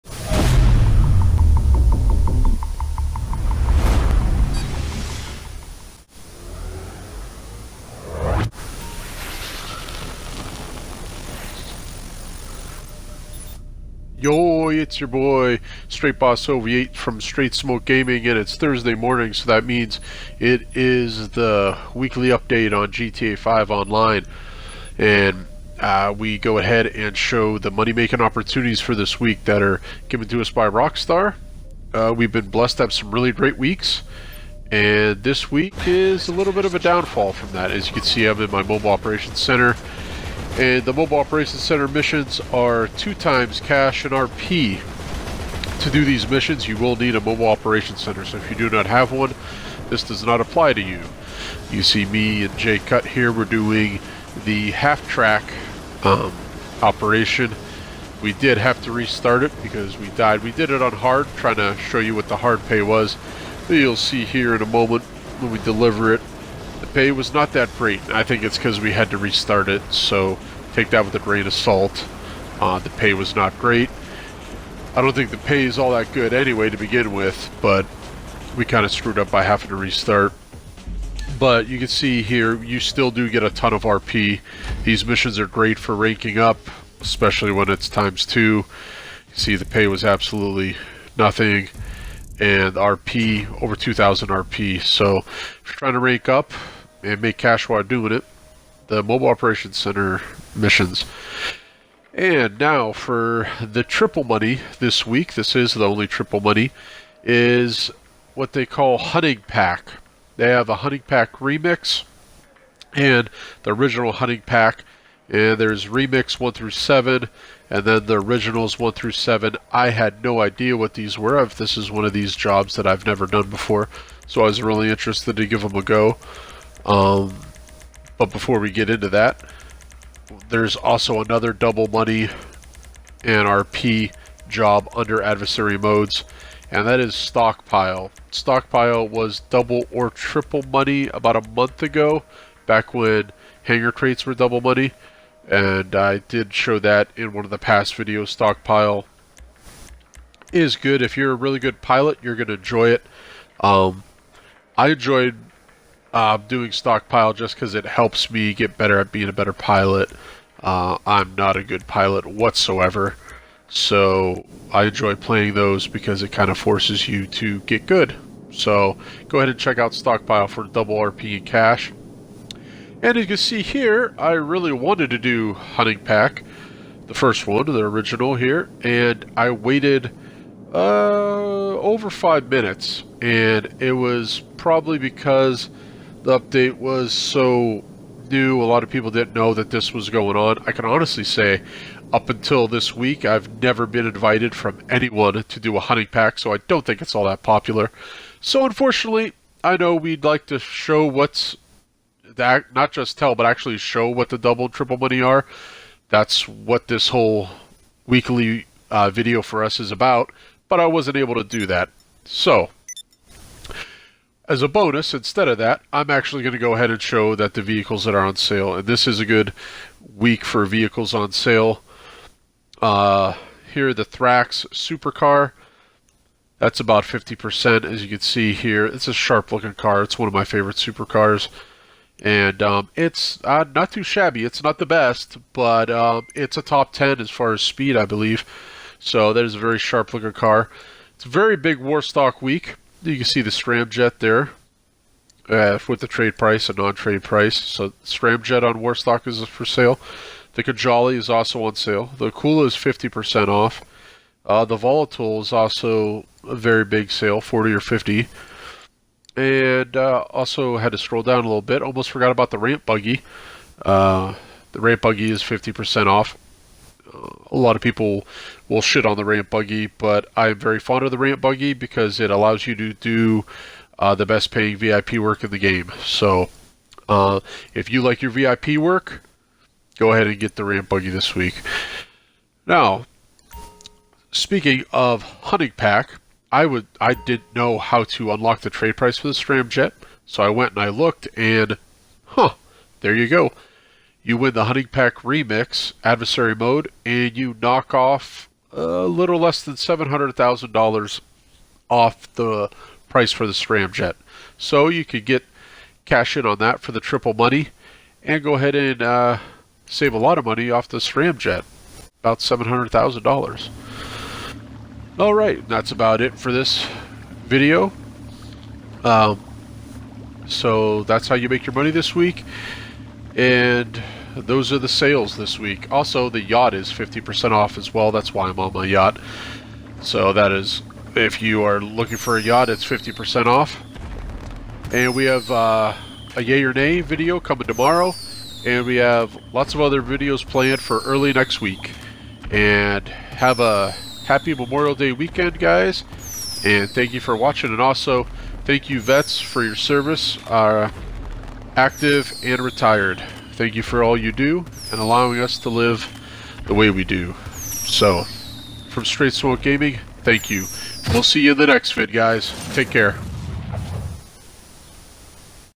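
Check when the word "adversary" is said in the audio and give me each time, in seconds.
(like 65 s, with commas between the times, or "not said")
135 s, 296 s.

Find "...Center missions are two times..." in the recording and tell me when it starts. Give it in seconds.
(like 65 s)
41 s.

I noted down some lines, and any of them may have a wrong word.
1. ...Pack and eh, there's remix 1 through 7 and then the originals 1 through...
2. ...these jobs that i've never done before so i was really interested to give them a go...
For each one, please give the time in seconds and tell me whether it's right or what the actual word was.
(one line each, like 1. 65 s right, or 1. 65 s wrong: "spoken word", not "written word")
1. 114 s right
2. 122 s right.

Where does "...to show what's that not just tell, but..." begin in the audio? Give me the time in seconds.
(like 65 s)
200 s.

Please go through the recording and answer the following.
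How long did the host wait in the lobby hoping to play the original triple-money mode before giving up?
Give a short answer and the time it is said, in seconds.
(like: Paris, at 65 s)
over 5 minutes, at 181 s.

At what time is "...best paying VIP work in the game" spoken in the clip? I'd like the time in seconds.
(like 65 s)
274 s.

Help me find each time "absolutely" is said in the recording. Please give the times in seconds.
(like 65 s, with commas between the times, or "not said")
90 s.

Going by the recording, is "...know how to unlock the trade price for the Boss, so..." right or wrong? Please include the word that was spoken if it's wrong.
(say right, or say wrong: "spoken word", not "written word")
wrong: "Scramjet", not "Boss".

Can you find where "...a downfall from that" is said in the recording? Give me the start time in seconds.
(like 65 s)
36 s.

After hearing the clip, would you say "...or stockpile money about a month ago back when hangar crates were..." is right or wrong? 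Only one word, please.
wrong.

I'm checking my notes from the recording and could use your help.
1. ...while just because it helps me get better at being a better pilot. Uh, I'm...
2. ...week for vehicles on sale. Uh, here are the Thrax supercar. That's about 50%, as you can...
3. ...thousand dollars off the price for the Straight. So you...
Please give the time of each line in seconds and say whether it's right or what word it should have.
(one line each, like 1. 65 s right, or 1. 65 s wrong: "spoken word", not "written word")
1. 156 s wrong: "stockpile", not "while"
2. 220 s right
3. 300 s wrong: "Scramjet", not "Straight".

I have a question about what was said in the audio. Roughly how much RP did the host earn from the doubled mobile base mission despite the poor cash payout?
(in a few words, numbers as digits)
over 2,000 RP.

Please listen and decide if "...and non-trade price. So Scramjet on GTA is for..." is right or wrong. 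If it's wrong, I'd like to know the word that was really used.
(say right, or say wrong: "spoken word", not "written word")
wrong: "Warstock", not "GTA".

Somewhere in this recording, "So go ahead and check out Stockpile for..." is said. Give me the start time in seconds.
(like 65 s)
168 s.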